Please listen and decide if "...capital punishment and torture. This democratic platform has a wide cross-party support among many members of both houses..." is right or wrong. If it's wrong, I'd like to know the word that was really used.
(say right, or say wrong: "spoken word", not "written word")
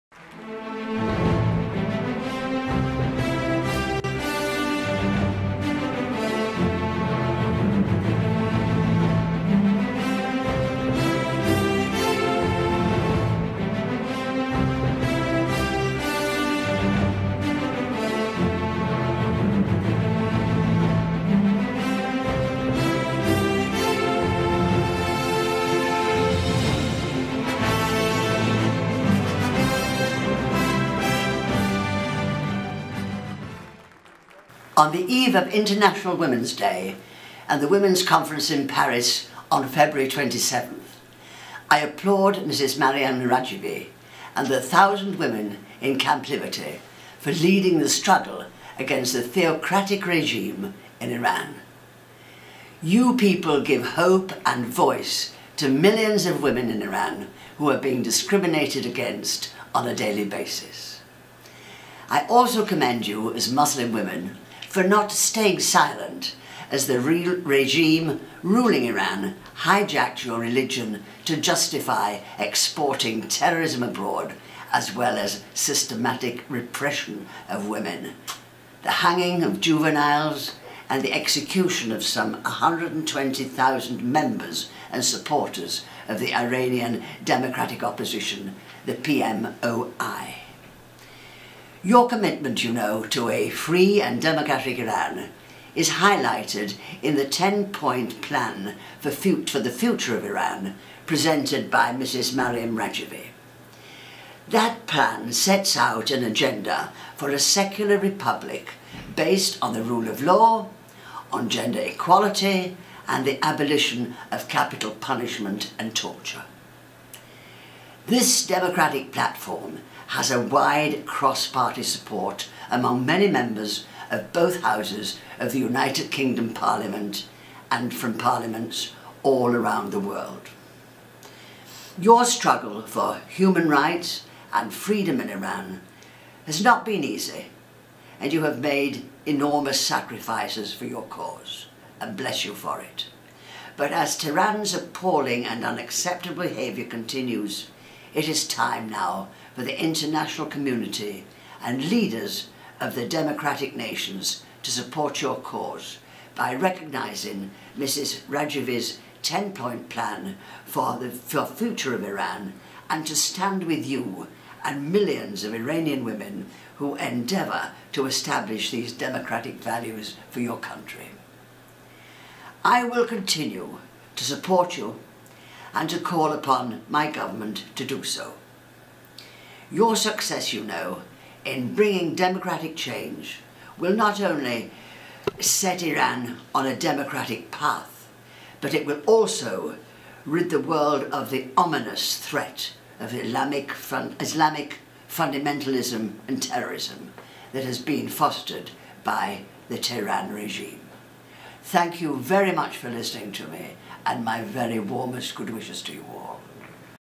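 right.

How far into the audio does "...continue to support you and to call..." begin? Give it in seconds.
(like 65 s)
173 s.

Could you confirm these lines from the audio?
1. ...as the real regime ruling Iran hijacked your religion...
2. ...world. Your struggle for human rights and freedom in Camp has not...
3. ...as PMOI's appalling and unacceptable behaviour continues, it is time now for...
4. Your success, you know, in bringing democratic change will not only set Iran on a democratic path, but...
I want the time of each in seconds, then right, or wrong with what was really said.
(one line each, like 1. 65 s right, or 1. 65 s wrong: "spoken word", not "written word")
1. 66 s right
2. 130 s wrong: "Iran", not "Camp"
3. 143 s wrong: "Tehran", not "PMOI"
4. 179 s right.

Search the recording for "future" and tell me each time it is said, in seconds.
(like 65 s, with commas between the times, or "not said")
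99 s, 161 s.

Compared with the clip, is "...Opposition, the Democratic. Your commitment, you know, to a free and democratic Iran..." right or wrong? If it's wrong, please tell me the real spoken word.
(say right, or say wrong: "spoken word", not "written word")
wrong: "PMOI", not "Democratic".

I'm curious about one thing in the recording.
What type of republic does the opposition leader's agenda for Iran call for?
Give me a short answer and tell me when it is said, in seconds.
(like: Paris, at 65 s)
secular republic, at 107 s.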